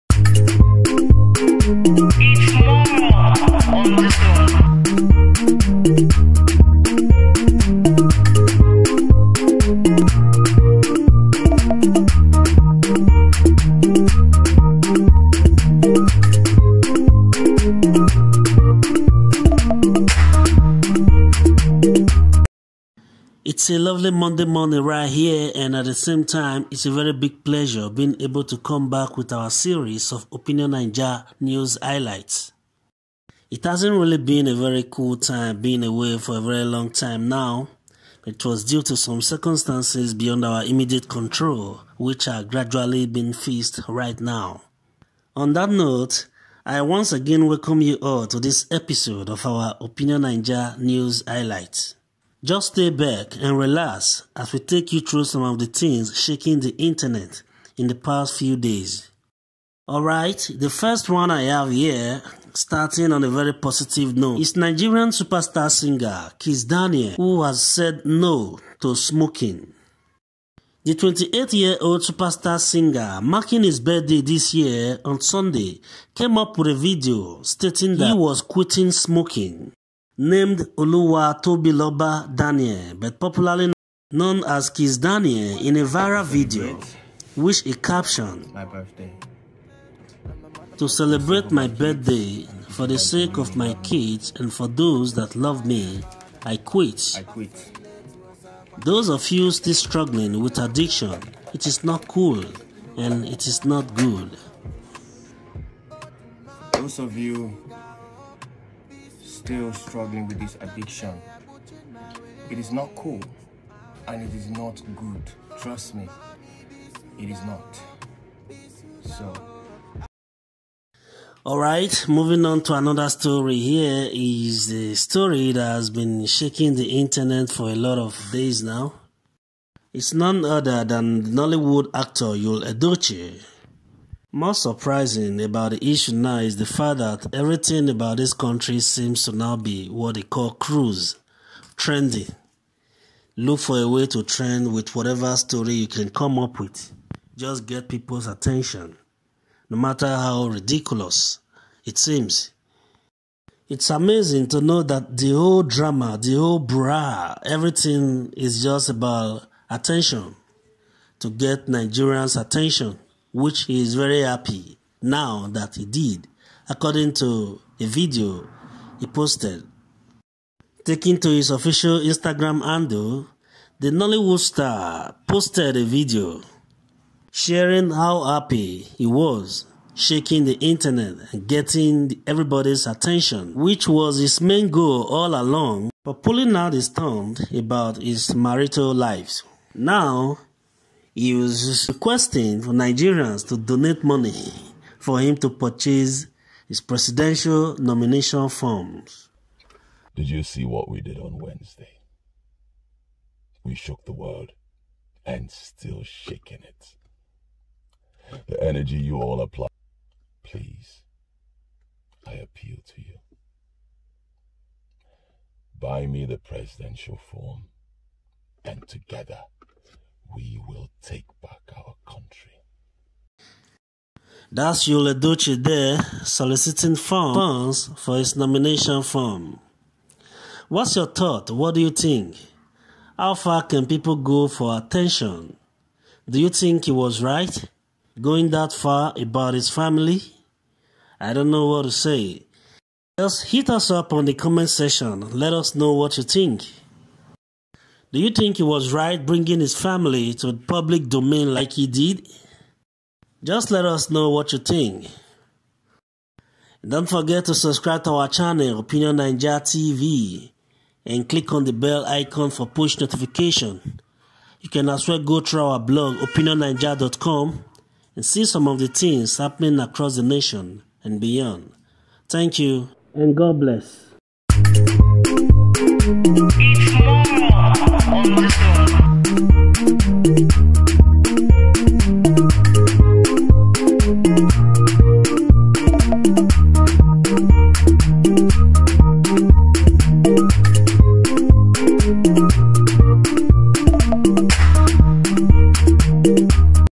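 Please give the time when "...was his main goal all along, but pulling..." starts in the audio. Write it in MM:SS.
03:03.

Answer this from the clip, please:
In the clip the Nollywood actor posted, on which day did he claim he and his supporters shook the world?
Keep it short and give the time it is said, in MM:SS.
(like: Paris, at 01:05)
Wednesday, at 03:21.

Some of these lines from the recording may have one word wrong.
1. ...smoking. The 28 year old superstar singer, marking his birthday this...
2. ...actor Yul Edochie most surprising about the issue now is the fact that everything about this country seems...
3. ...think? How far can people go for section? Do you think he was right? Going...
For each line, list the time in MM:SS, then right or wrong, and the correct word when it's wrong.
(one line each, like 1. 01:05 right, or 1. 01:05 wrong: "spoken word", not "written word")
1. 01:08 right
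2. 02:11 right
3. 03:51 wrong: "attention", not "section".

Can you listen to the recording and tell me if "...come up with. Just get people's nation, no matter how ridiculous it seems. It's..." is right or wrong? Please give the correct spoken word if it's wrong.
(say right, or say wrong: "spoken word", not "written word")
wrong: "attention", not "nation".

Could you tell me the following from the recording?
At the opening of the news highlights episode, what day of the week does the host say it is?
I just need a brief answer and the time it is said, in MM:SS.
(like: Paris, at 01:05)
Monday, at 00:24.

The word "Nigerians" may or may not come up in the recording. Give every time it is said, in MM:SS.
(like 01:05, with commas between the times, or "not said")
01:04, 02:41, 03:12.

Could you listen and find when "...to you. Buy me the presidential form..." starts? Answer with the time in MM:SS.
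03:32.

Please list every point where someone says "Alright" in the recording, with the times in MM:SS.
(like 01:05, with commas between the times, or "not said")
00:59.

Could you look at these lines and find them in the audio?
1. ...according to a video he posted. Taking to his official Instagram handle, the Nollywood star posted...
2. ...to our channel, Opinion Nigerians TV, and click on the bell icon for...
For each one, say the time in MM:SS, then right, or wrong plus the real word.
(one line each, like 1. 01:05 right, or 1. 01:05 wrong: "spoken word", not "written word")
1. 02:46 right
2. 04:18 wrong: "Naija", not "Nigerians".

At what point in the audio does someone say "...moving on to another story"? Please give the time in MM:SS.
02:02.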